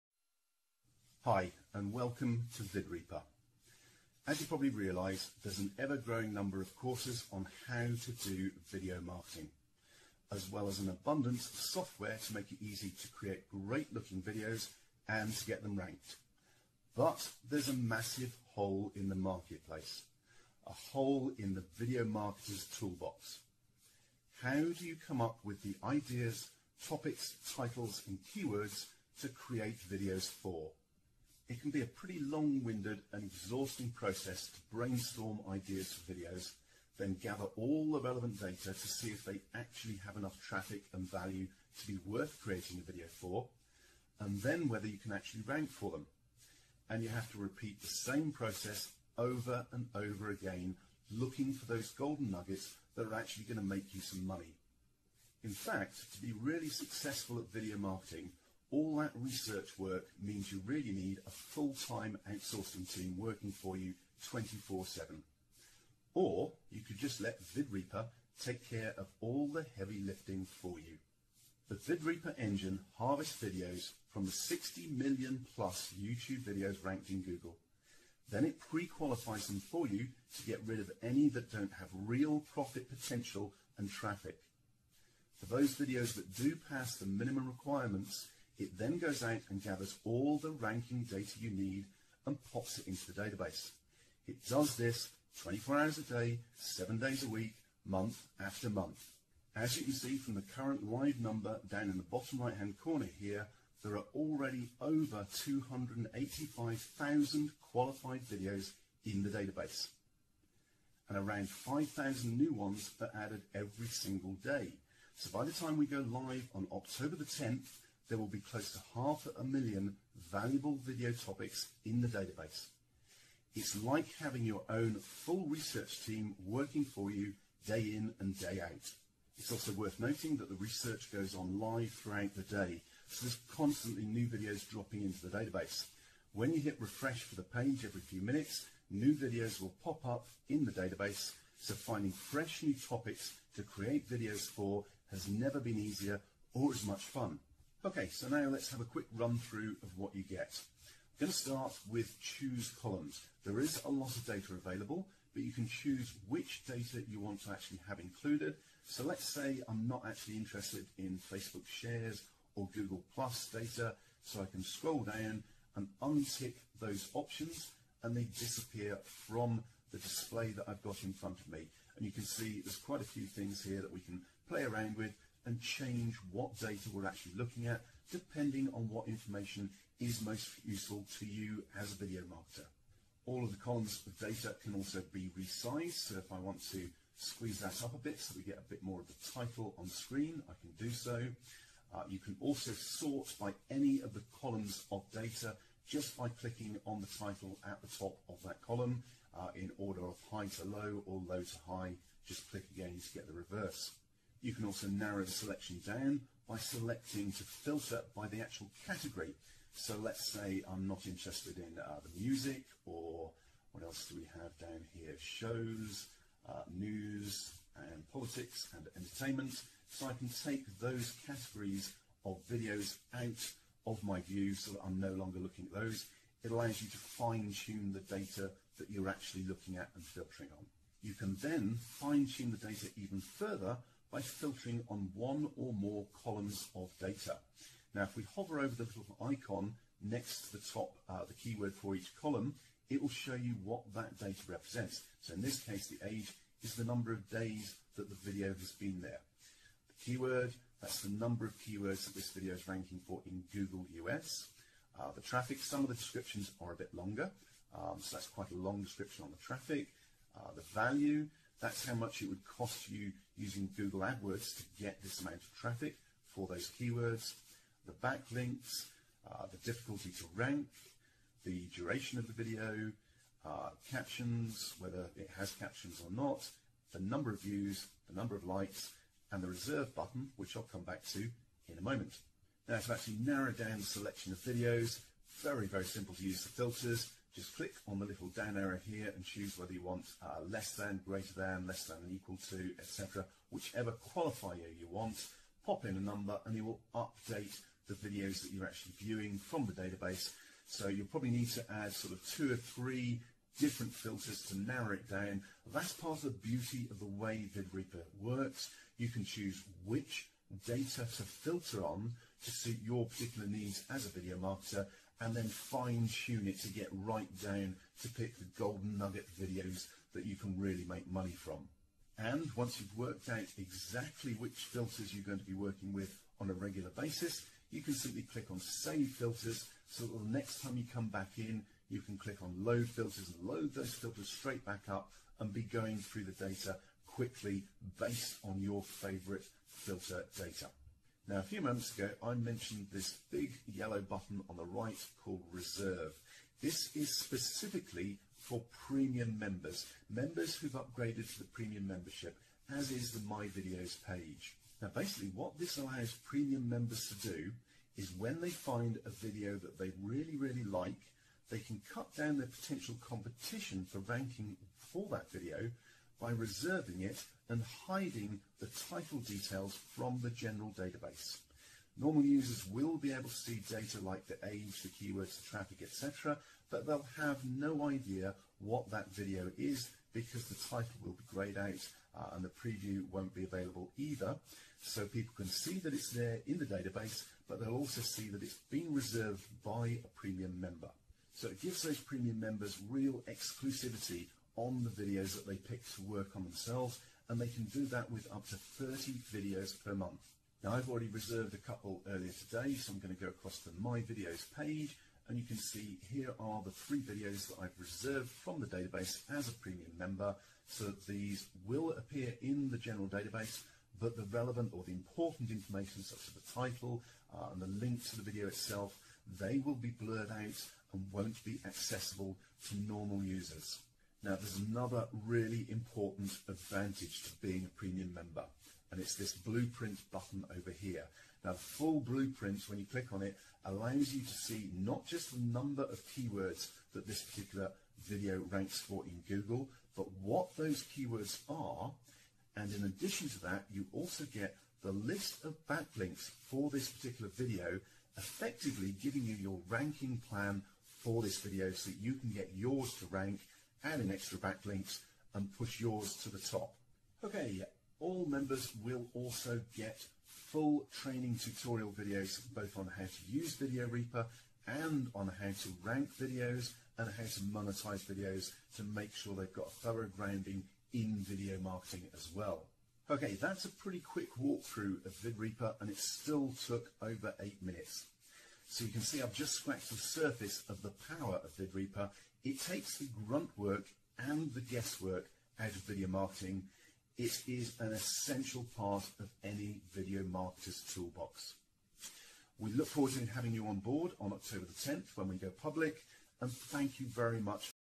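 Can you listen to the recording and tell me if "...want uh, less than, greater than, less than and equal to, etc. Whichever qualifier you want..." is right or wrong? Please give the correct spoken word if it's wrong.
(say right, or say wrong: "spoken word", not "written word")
right.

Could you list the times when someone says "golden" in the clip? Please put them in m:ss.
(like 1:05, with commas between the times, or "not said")
0:51, 5:18.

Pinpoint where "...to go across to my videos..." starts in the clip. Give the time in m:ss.
6:43.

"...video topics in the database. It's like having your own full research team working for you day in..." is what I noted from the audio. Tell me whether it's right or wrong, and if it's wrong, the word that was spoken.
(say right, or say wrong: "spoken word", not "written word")
right.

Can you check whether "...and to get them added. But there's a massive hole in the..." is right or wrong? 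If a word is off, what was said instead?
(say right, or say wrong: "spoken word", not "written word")
wrong: "ranked", not "added".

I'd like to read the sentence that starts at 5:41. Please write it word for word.
Now, a few moments ago, I mentioned this big yellow button on the right called Reserve.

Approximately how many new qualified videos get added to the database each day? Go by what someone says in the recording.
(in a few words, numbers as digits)
around 5,000.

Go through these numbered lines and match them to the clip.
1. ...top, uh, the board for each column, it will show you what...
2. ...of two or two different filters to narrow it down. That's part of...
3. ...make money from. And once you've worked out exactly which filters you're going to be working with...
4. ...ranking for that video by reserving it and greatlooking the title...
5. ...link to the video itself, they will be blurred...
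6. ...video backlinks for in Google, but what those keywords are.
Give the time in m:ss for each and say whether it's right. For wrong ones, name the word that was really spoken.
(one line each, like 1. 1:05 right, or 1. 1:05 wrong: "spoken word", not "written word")
1. 4:00 wrong: "keyword", not "board"
2. 5:02 wrong: "three", not "two"
3. 5:20 right
4. 6:03 wrong: "hiding", not "greatlooking"
5. 6:57 right
6. 7:18 wrong: "ranks", not "backlinks".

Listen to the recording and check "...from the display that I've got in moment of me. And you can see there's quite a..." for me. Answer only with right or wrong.
wrong.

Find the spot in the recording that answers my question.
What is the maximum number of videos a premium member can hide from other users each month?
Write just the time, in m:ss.
6:38.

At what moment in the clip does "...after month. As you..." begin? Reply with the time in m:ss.
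1:38.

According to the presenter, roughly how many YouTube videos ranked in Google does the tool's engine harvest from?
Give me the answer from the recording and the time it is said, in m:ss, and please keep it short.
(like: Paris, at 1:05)
60 million plus, at 1:14.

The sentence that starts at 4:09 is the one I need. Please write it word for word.
The keyword, that's the number of keywords that this video is ranking for in Google US.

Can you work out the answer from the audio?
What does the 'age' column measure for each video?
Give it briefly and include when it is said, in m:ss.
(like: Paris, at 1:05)
number of days, at 4:06.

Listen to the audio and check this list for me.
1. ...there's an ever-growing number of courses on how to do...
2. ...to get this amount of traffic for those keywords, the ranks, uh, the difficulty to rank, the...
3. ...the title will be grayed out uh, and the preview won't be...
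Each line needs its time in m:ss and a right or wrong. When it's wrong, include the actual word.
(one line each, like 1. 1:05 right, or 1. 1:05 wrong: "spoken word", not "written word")
1. 0:05 right
2. 4:24 wrong: "backlinks", not "ranks"
3. 6:20 right.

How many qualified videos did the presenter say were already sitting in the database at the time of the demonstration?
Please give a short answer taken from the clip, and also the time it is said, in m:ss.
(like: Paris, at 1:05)
over 285,000, at 1:44.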